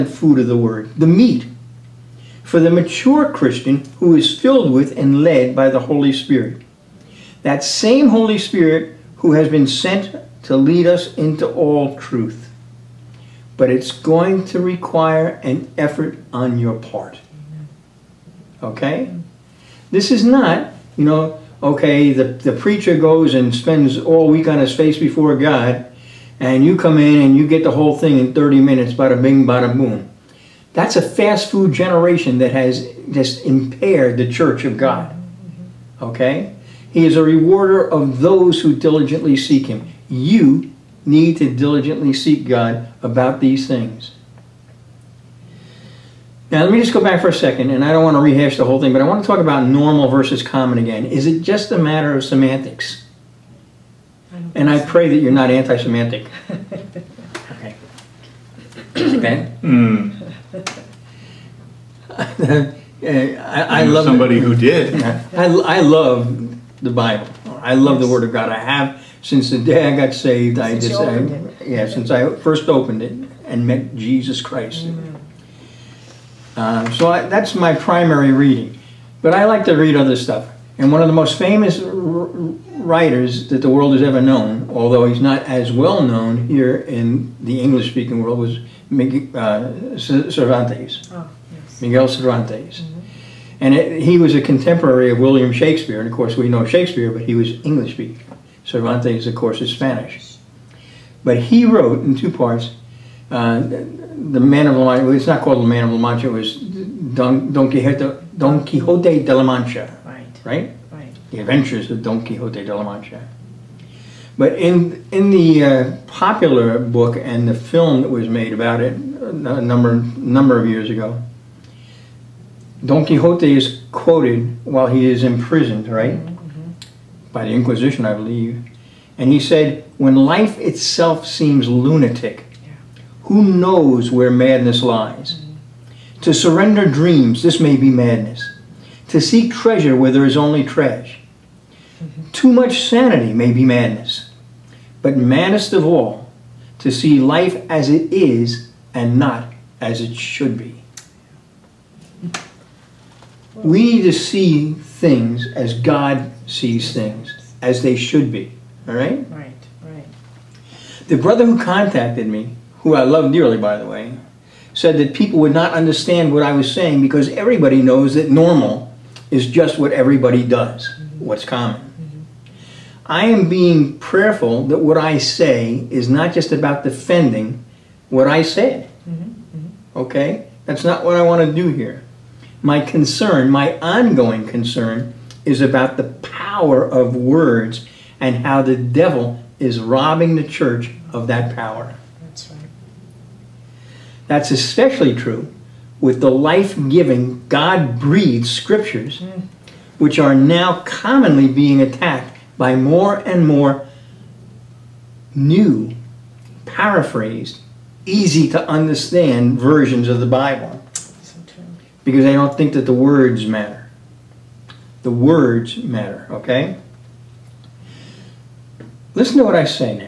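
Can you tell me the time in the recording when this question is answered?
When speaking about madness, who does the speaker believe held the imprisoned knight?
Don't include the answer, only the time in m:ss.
2:07.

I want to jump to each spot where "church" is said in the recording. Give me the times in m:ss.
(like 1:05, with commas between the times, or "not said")
0:34, 3:10.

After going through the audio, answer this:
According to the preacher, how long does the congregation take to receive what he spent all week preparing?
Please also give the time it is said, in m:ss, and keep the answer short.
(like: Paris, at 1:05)
30 minutes, at 0:28.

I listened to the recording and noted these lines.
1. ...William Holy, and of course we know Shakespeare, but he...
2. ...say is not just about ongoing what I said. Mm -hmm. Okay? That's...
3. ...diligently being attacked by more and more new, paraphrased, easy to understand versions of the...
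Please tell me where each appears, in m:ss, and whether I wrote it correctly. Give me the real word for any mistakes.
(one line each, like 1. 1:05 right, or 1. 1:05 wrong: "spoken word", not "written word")
1. 1:35 wrong: "Shakespeare", not "Holy"
2. 2:55 wrong: "defending", not "ongoing"
3. 3:20 wrong: "commonly", not "diligently".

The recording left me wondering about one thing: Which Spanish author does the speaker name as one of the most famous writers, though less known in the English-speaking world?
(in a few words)
Miguel Cervantes.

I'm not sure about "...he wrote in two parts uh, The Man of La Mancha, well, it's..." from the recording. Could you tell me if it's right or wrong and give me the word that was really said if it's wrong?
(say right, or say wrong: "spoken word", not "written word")
right.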